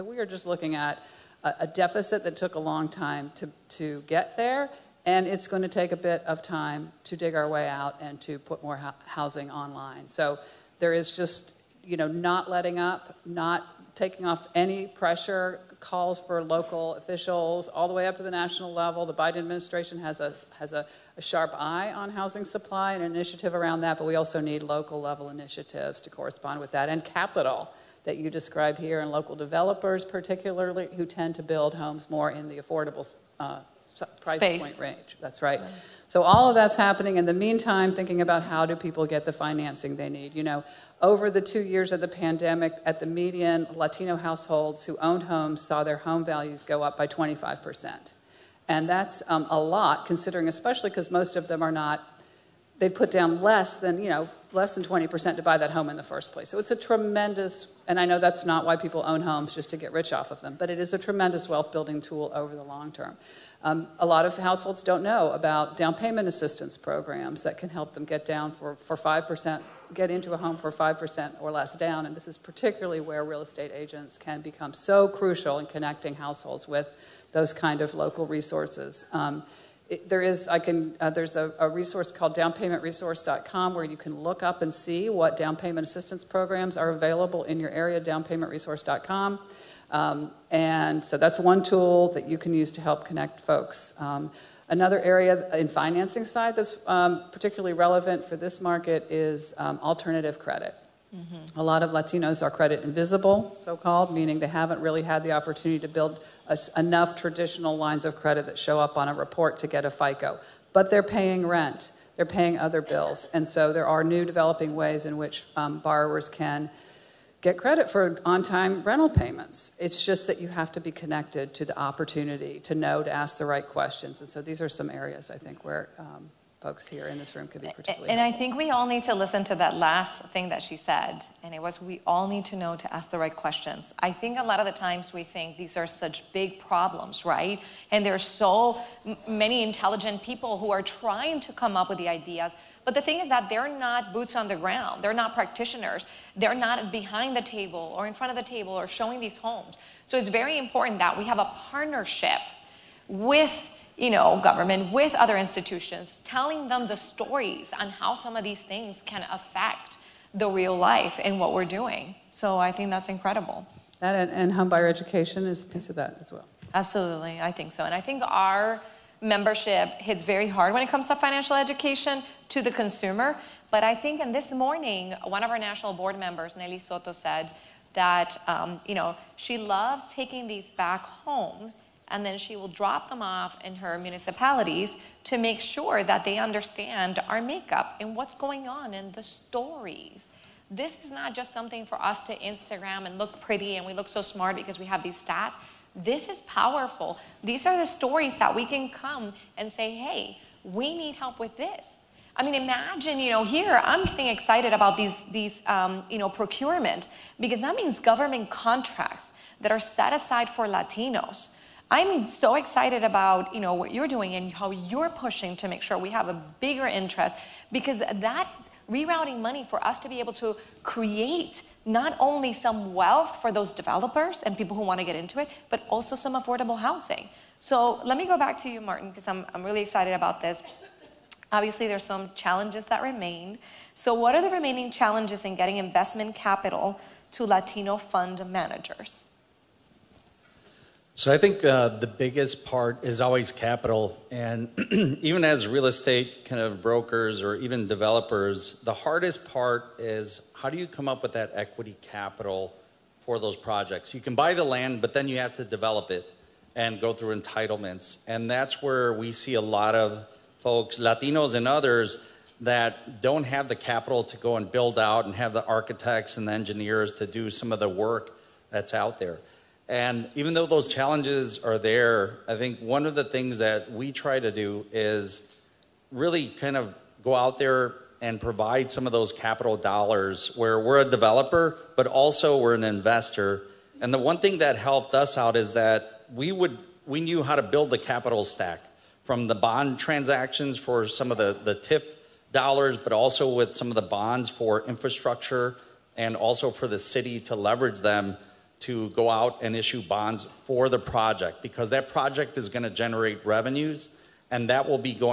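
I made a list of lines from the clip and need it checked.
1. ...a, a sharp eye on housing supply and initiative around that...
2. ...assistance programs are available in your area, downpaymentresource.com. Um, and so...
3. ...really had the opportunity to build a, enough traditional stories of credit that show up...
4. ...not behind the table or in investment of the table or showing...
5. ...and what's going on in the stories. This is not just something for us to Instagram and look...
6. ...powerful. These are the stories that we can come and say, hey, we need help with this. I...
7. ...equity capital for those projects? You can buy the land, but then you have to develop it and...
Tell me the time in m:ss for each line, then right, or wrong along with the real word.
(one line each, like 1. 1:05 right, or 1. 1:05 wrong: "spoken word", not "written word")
1. 0:20 right
2. 1:25 right
3. 1:44 wrong: "lines", not "stories"
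4. 2:26 wrong: "front", not "investment"
5. 3:07 right
6. 3:16 right
7. 4:11 right.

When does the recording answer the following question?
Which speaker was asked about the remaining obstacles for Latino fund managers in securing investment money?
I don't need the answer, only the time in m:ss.
3:48.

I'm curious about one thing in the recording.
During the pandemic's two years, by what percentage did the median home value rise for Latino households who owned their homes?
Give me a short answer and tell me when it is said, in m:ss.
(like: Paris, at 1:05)
25%, at 0:47.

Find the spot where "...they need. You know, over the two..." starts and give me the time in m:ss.
0:39.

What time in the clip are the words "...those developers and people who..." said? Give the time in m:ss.
3:43.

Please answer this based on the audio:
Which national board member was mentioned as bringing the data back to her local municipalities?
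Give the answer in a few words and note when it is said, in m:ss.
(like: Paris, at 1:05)
Nelly Soto, at 2:56.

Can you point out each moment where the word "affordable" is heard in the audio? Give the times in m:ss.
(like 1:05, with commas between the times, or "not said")
0:32, 3:46.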